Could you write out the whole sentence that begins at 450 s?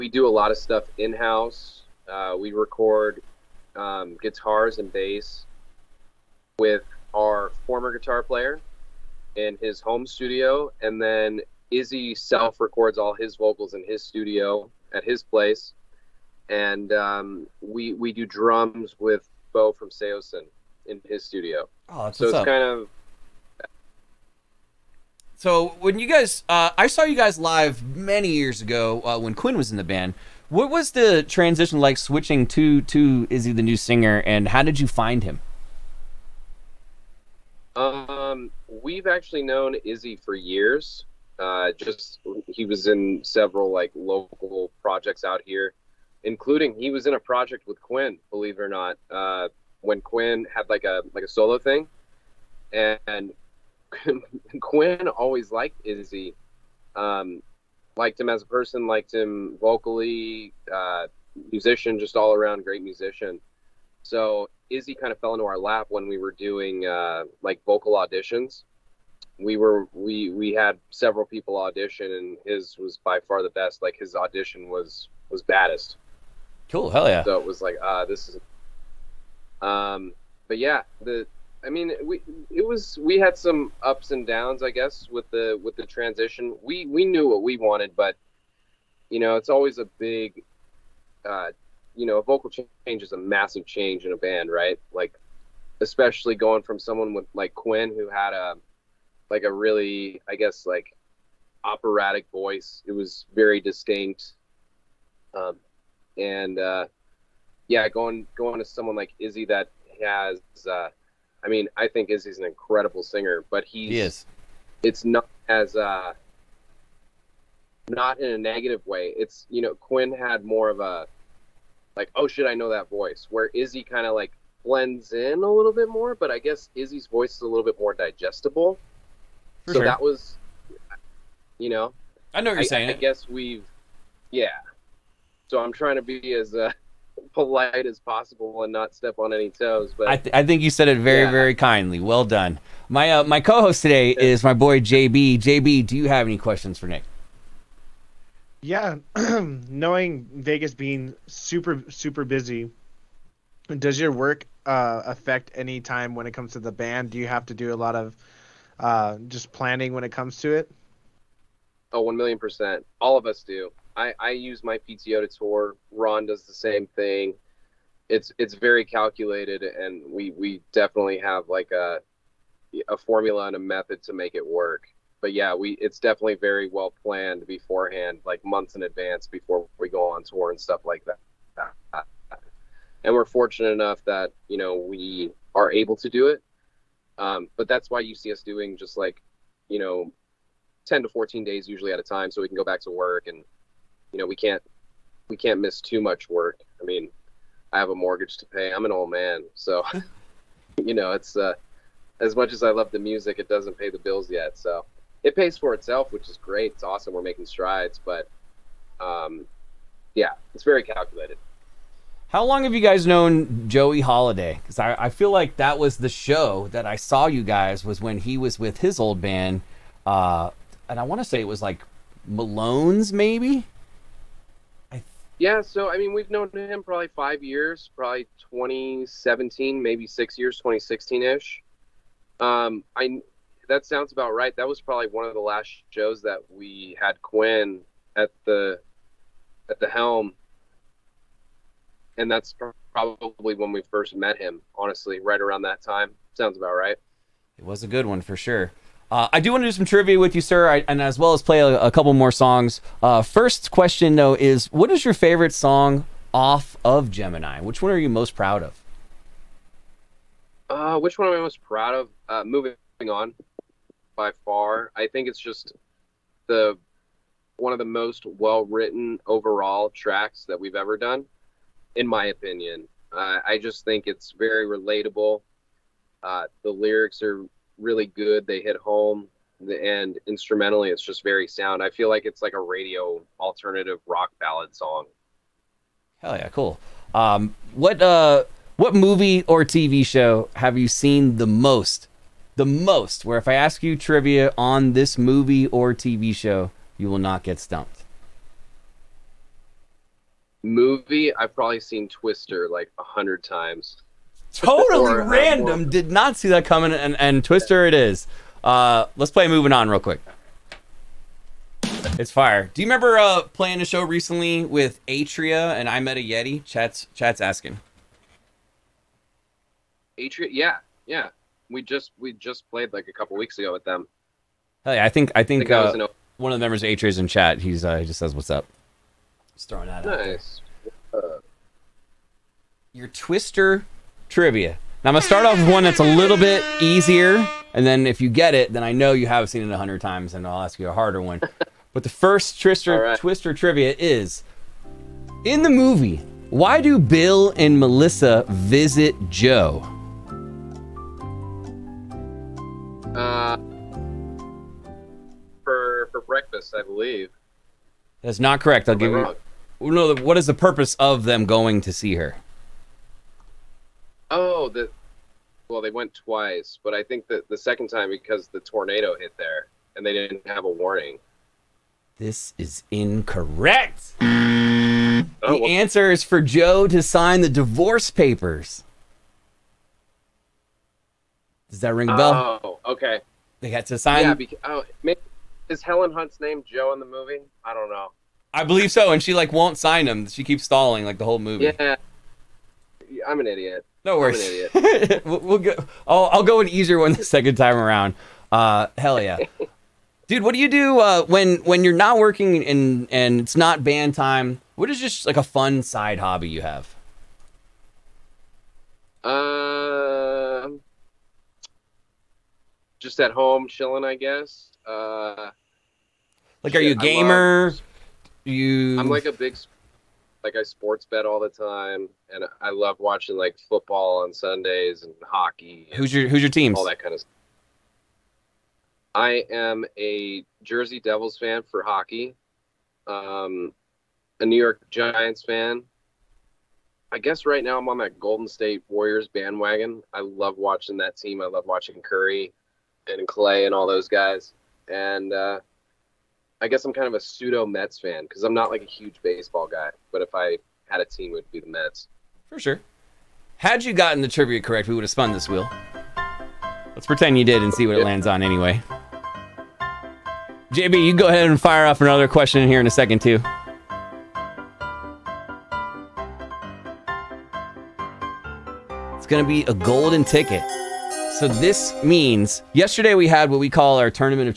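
But if I had a team, it would be the Mets.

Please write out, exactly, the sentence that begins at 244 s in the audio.
Honestly, right around that time, sounds about right.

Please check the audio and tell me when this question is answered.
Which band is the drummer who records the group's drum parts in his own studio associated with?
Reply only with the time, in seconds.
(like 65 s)
19 s.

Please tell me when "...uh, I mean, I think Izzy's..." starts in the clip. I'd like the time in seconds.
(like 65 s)
110 s.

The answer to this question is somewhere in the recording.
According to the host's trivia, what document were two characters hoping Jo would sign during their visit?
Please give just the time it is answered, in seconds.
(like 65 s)
377 s.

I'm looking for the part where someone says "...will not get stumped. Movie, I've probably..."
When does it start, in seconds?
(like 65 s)
297 s.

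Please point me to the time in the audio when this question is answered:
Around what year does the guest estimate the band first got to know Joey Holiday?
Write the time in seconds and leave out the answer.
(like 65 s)
228 s.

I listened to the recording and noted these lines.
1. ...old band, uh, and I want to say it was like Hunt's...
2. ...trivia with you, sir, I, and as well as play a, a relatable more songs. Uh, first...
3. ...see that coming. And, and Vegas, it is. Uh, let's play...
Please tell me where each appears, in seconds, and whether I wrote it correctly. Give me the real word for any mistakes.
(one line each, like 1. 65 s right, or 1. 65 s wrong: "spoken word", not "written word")
1. 219 s wrong: "Malone", not "Hunt"
2. 249 s wrong: "couple", not "relatable"
3. 306 s wrong: "Twister", not "Vegas".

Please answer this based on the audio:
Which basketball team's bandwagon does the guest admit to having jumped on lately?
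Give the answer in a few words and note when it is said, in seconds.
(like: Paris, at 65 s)
Golden State Warriors, at 438 s.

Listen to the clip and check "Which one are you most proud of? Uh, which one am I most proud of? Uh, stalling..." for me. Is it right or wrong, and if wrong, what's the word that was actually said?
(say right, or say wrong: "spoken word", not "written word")
wrong: "moving", not "stalling".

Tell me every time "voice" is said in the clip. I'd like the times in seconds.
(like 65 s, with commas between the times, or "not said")
102 s, 122 s, 127 s.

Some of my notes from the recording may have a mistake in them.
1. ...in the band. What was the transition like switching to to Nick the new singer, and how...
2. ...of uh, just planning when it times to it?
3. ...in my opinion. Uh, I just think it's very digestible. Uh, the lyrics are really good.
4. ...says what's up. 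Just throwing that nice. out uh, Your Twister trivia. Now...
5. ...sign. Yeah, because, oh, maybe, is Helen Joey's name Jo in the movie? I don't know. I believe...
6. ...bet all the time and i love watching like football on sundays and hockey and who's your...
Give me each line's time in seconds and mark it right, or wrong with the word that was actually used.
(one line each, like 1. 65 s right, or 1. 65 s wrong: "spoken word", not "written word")
1. 29 s wrong: "Izzy", not "Nick"
2. 157 s wrong: "comes", not "times"
3. 271 s wrong: "relatable", not "digestible"
4. 328 s right
5. 383 s wrong: "Hunt", not "Joey"
6. 421 s right.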